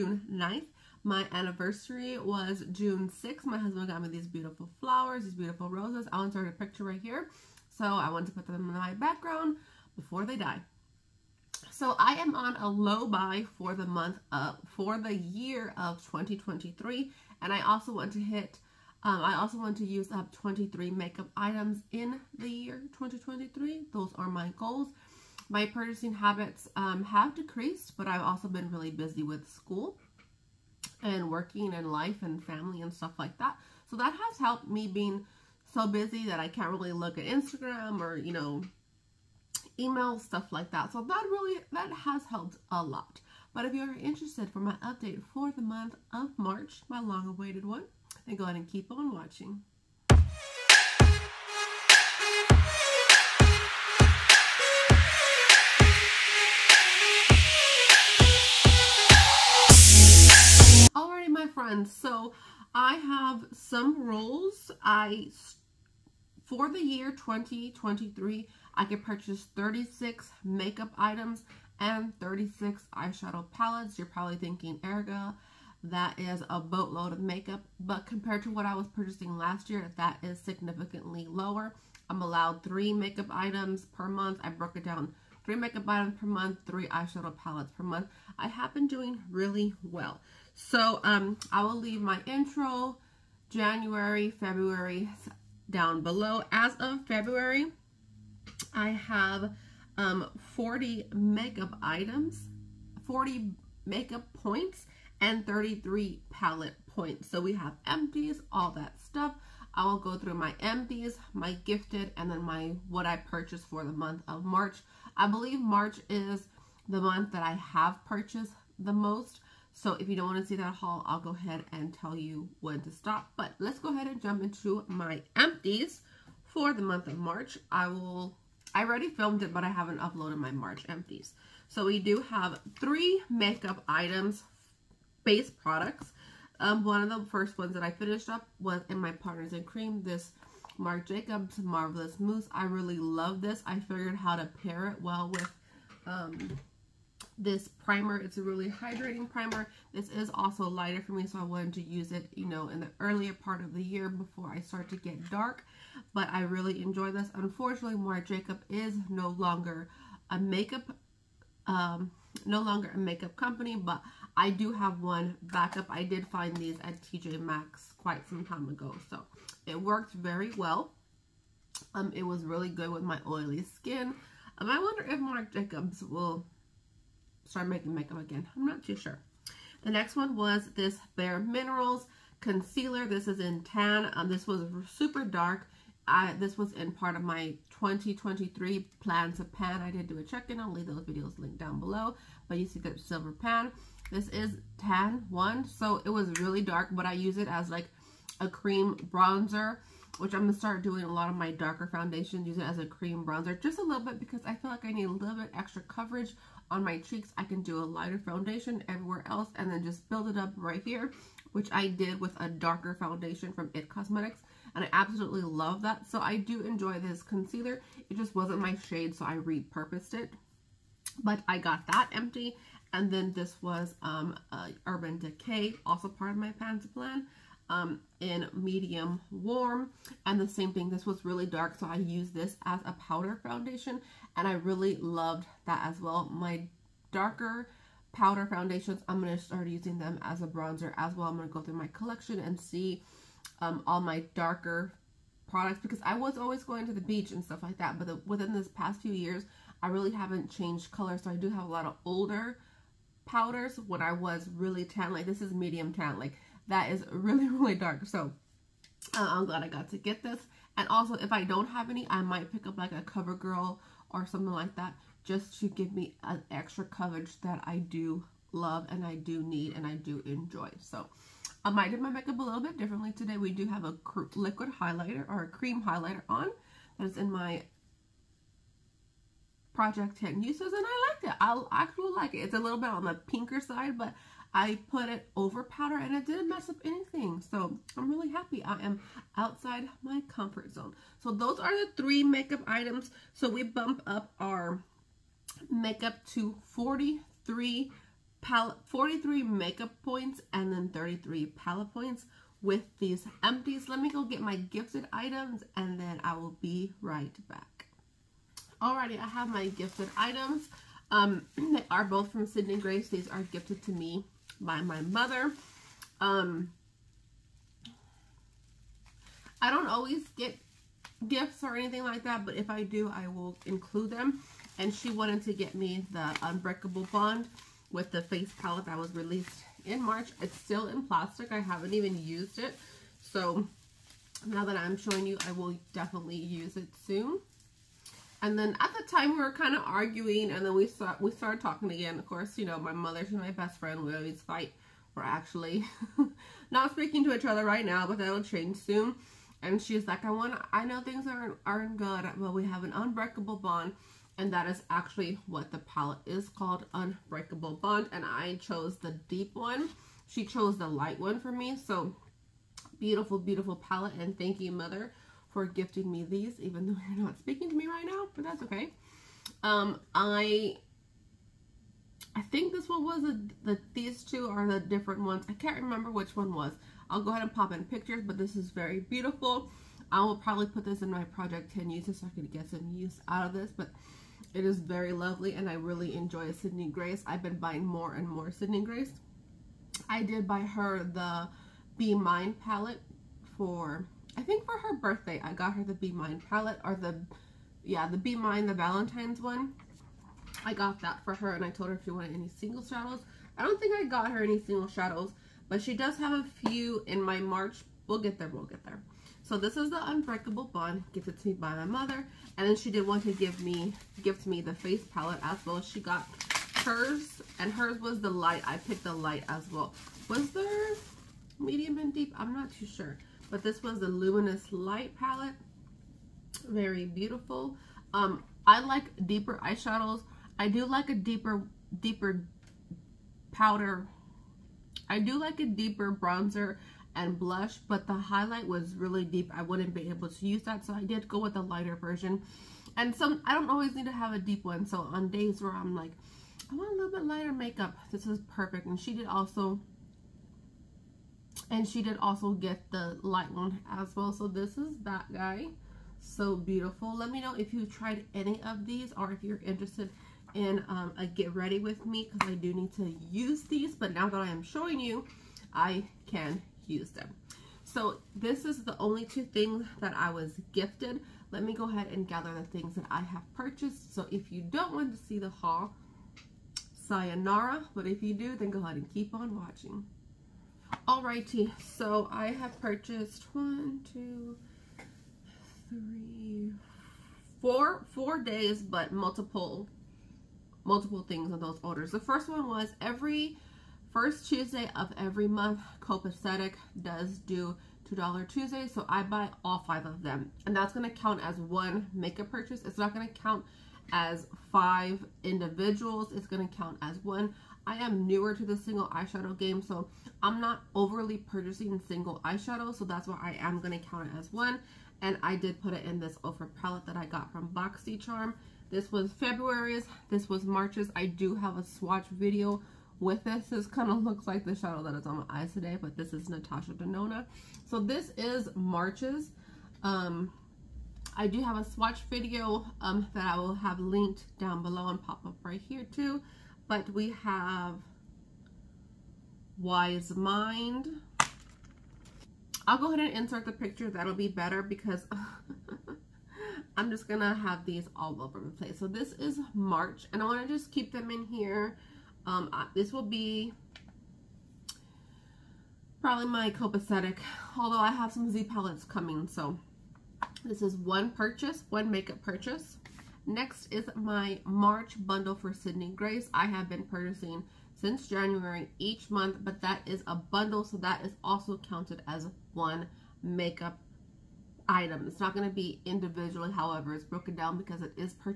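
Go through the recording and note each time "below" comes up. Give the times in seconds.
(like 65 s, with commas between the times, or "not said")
96 s, 191 s, 534 s.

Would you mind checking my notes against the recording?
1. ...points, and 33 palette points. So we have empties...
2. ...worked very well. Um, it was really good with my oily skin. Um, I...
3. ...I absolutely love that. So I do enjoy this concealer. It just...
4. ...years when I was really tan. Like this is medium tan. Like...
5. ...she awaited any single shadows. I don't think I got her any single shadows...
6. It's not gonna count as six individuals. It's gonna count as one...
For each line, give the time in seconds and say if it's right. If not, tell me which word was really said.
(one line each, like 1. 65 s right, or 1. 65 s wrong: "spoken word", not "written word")
1. 104 s right
2. 169 s right
3. 214 s right
4. 253 s wrong: "powders", not "years"
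5. 402 s wrong: "wanted", not "awaited"
6. 502 s wrong: "five", not "six".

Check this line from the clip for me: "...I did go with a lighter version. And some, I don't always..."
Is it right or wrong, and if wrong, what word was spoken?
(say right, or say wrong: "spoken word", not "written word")
right.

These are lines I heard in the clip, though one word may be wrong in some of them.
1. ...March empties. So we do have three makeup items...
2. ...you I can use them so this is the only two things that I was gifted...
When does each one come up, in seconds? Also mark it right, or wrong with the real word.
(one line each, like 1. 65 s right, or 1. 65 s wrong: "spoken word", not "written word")
1. 130 s right
2. 464 s right.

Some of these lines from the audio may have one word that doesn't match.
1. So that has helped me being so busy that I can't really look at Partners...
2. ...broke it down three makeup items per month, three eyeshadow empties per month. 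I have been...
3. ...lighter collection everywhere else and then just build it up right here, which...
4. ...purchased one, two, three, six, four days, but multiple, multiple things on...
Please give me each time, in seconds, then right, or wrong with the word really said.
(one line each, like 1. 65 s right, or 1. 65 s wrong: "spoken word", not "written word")
1. 33 s wrong: "Instagram", not "Partners"
2. 84 s wrong: "palettes", not "empties"
3. 207 s wrong: "foundation", not "collection"
4. 482 s wrong: "four", not "six".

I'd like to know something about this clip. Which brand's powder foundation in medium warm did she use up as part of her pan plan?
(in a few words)
Urban Decay.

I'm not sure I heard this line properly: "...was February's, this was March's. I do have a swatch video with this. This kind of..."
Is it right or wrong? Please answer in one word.
right.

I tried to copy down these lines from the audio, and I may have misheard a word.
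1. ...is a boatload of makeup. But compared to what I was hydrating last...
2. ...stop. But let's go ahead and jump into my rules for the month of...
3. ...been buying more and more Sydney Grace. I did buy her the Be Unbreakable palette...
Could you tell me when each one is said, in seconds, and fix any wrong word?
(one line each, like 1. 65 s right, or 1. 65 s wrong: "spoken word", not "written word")
1. 76 s wrong: "purchasing", not "hydrating"
2. 122 s wrong: "empties", not "rules"
3. 387 s wrong: "Mine", not "Unbreakable".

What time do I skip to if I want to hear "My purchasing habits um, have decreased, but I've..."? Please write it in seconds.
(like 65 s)
25 s.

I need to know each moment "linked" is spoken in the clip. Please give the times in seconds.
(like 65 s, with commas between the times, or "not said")
191 s, 533 s.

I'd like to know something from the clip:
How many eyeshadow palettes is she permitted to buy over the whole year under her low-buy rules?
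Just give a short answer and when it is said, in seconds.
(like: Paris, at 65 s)
36, at 72 s.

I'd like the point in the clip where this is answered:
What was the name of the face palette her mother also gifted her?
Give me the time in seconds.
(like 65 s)
424 s.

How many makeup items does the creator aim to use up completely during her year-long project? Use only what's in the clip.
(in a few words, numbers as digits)
23.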